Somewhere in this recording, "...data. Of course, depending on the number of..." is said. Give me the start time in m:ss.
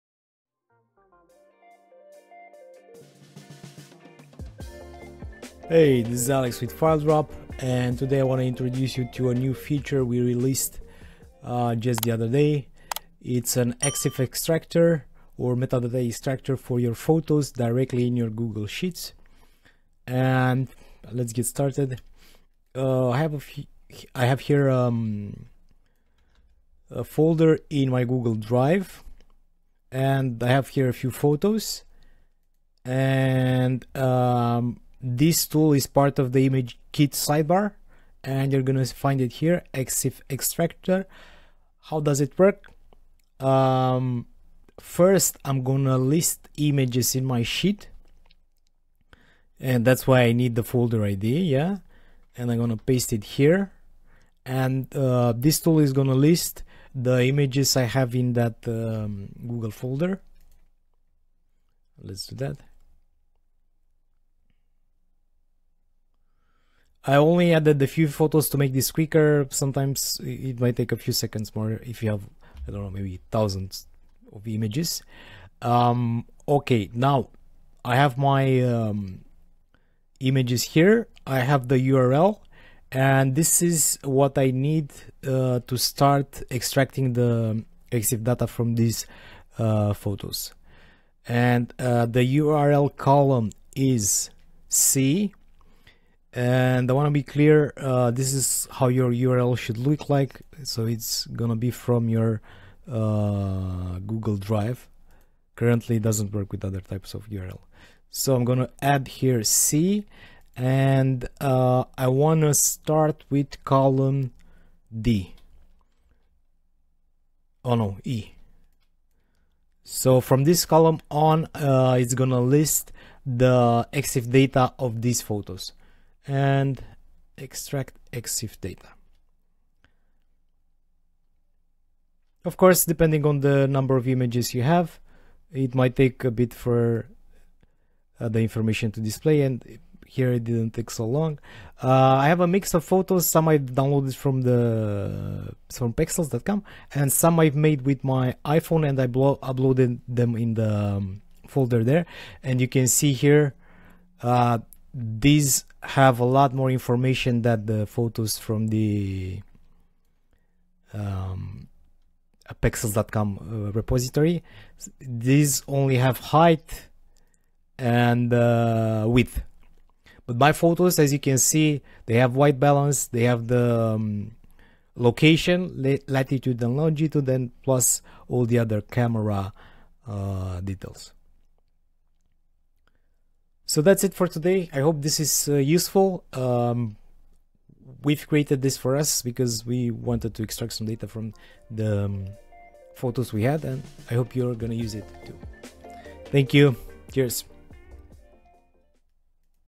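2:08.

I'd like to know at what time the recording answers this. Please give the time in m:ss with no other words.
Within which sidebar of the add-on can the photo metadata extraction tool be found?
0:36.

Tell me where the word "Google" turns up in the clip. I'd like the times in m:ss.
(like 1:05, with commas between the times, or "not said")
0:18, 0:28, 0:59, 1:43.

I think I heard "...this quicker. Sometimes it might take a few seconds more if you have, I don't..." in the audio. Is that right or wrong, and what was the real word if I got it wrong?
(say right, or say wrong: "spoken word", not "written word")
right.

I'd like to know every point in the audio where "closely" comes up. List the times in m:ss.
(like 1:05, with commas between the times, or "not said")
not said.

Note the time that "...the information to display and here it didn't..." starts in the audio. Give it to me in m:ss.
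2:18.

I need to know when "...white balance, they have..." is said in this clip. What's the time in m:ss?
2:52.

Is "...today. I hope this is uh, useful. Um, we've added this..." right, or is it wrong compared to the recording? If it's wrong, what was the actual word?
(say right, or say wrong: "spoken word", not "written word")
wrong: "created", not "added".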